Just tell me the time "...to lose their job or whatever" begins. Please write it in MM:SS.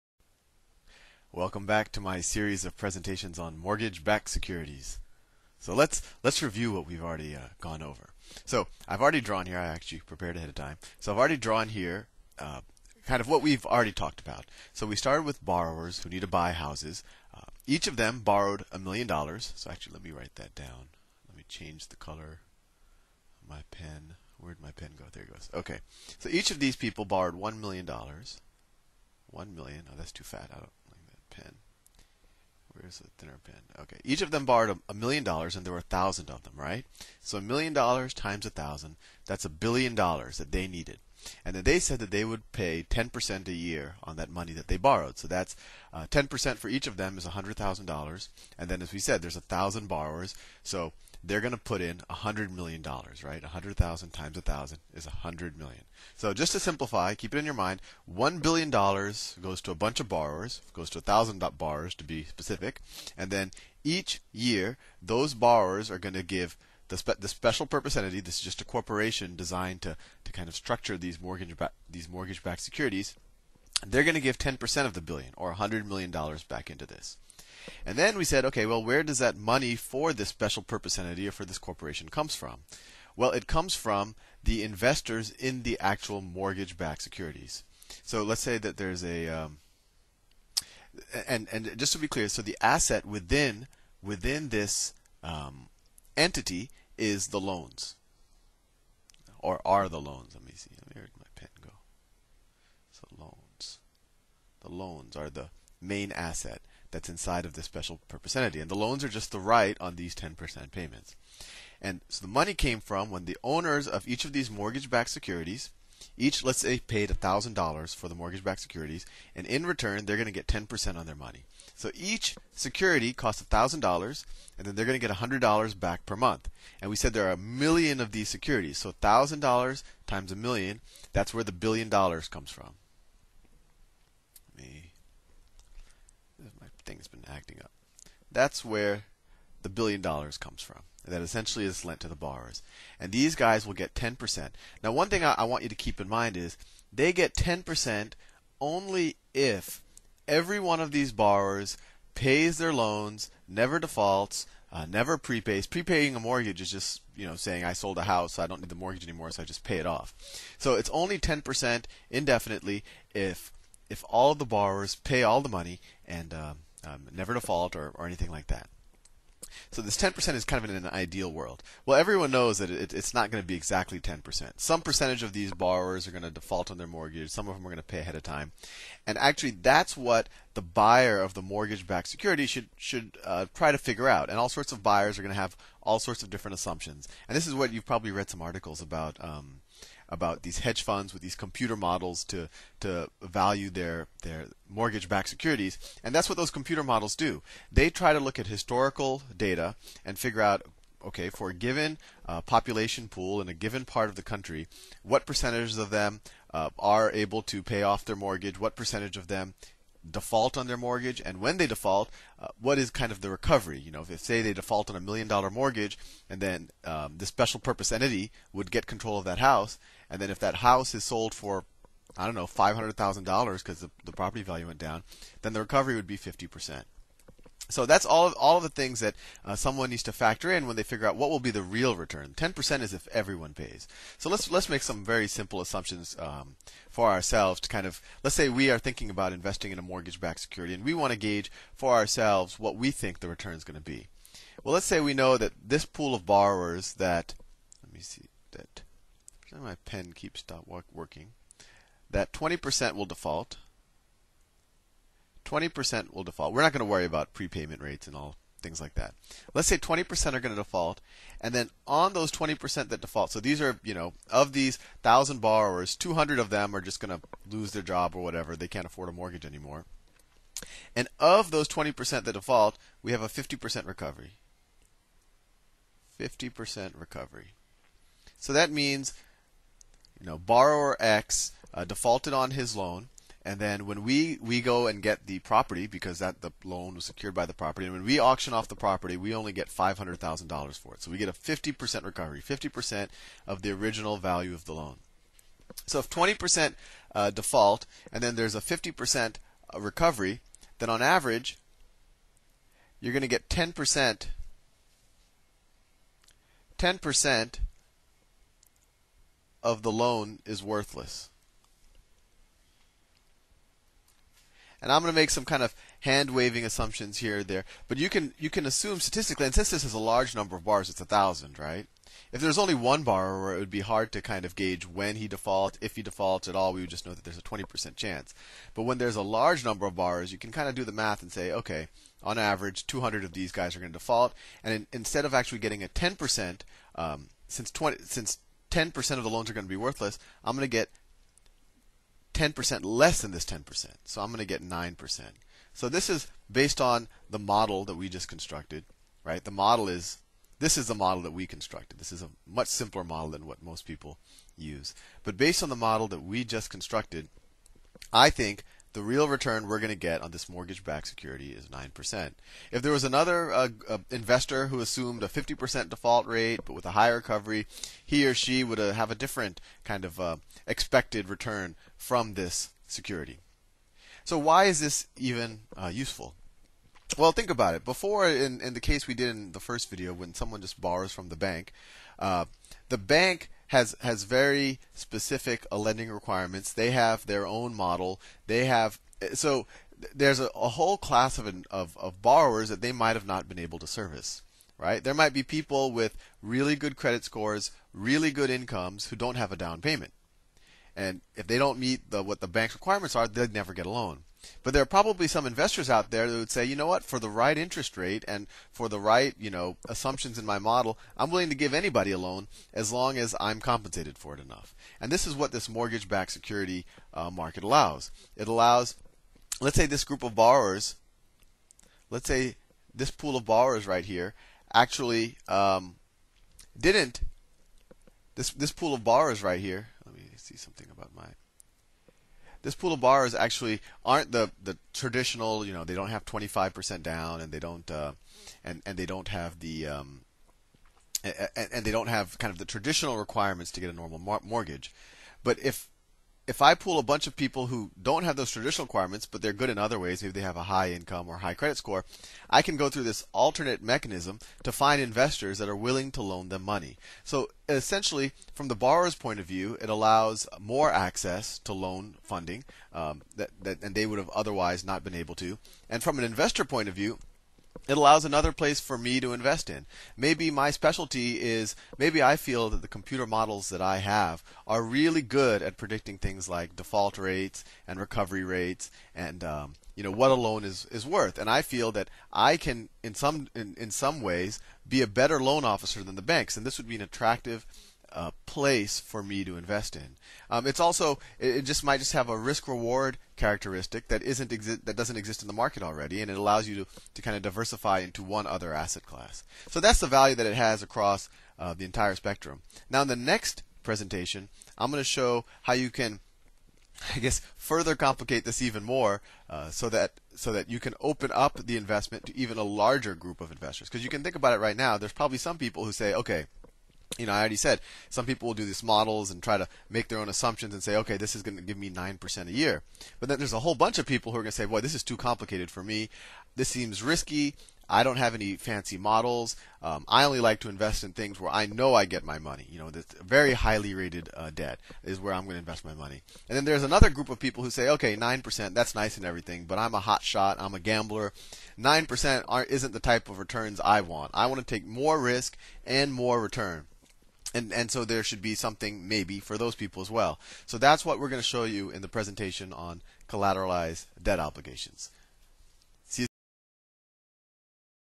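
04:27.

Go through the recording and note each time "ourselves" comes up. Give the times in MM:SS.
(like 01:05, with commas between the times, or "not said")
03:57, 04:01.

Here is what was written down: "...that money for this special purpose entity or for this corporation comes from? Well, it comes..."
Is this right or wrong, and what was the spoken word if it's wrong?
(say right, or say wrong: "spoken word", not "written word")
right.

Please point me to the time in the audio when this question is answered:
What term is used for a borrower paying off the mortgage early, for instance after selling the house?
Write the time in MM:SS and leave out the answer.
02:35.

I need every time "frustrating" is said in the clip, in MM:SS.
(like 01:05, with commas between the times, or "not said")
not said.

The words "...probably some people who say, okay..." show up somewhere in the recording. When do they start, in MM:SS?
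08:35.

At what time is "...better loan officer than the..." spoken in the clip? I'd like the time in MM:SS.
08:05.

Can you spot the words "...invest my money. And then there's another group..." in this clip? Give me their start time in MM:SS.
08:55.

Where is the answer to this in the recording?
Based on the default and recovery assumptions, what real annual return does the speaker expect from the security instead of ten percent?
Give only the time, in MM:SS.
05:44.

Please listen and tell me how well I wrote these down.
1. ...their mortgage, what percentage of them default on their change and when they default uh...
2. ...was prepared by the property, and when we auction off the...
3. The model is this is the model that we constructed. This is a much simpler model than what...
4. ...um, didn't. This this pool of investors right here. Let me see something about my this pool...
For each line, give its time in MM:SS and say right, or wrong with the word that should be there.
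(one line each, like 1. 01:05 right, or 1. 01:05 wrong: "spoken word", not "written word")
1. 03:28 wrong: "mortgage", not "change"
2. 04:46 wrong: "secured", not "prepared"
3. 05:49 right
4. 07:05 wrong: "borrowers", not "investors".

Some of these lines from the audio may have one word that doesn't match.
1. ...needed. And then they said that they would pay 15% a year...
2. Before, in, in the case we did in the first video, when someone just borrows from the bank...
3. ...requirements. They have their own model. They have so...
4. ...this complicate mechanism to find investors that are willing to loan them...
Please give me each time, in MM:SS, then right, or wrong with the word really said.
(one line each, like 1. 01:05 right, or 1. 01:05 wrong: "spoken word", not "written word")
1. 00:40 wrong: "10", not "15"
2. 06:17 right
3. 06:26 right
4. 07:33 wrong: "alternate", not "complicate".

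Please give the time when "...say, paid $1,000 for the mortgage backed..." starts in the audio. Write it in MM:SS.
01:56.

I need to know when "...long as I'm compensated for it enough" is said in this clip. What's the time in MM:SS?
06:52.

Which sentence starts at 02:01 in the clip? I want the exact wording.
So each security costs $1,000, and then they're going to get $100 back per month.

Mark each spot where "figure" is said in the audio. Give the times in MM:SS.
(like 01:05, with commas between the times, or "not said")
03:03, 03:20, 03:50.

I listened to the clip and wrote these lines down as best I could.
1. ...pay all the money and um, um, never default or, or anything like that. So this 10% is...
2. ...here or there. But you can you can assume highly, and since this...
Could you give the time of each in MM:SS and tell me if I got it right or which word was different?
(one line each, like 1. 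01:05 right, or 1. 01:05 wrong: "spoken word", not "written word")
1. 02:44 right
2. 05:17 wrong: "statistically", not "highly".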